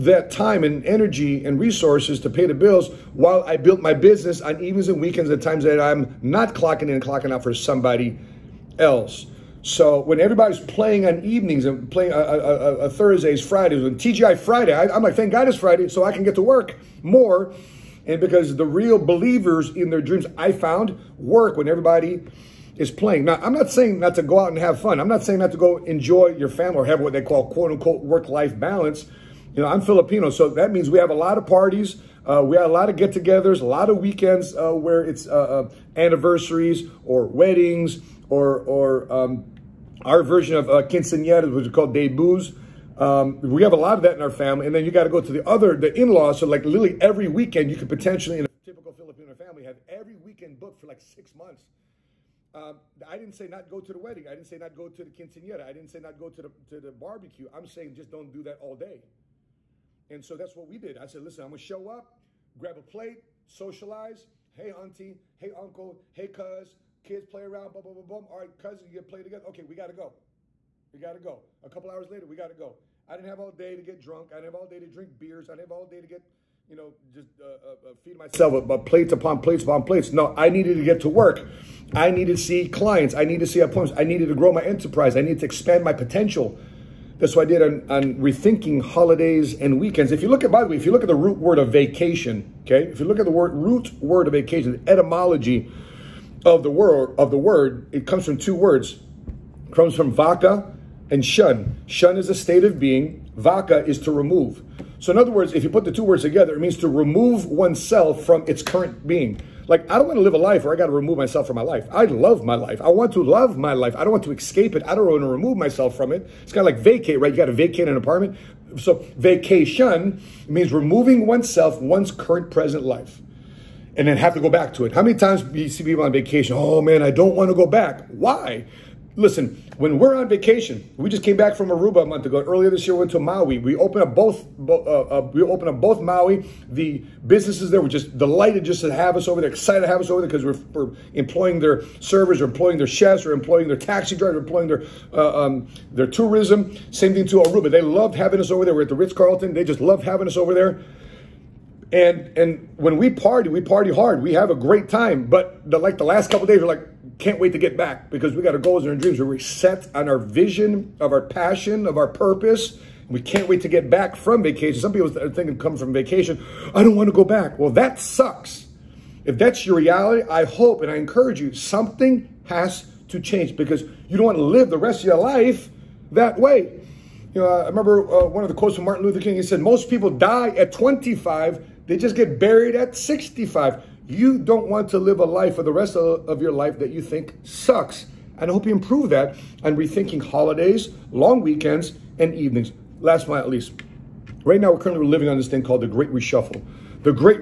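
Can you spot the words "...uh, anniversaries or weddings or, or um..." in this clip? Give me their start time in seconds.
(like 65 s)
35 s.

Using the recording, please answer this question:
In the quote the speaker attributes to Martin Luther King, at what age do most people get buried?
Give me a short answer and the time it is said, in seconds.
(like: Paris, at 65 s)
65, at 182 s.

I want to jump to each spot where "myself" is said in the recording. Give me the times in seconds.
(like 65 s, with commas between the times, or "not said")
78 s, 111 s, 115 s.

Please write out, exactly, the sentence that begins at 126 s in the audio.
Oh man, I don't want to go back.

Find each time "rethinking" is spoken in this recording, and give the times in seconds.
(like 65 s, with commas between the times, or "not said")
88 s, 189 s.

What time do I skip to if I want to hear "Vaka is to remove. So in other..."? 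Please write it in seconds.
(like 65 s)
103 s.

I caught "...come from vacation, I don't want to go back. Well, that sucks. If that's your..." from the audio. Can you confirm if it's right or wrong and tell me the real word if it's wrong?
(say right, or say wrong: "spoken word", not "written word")
right.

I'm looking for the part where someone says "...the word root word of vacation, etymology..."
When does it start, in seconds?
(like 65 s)
93 s.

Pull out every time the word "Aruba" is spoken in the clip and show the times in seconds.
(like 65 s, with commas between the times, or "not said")
131 s, 147 s.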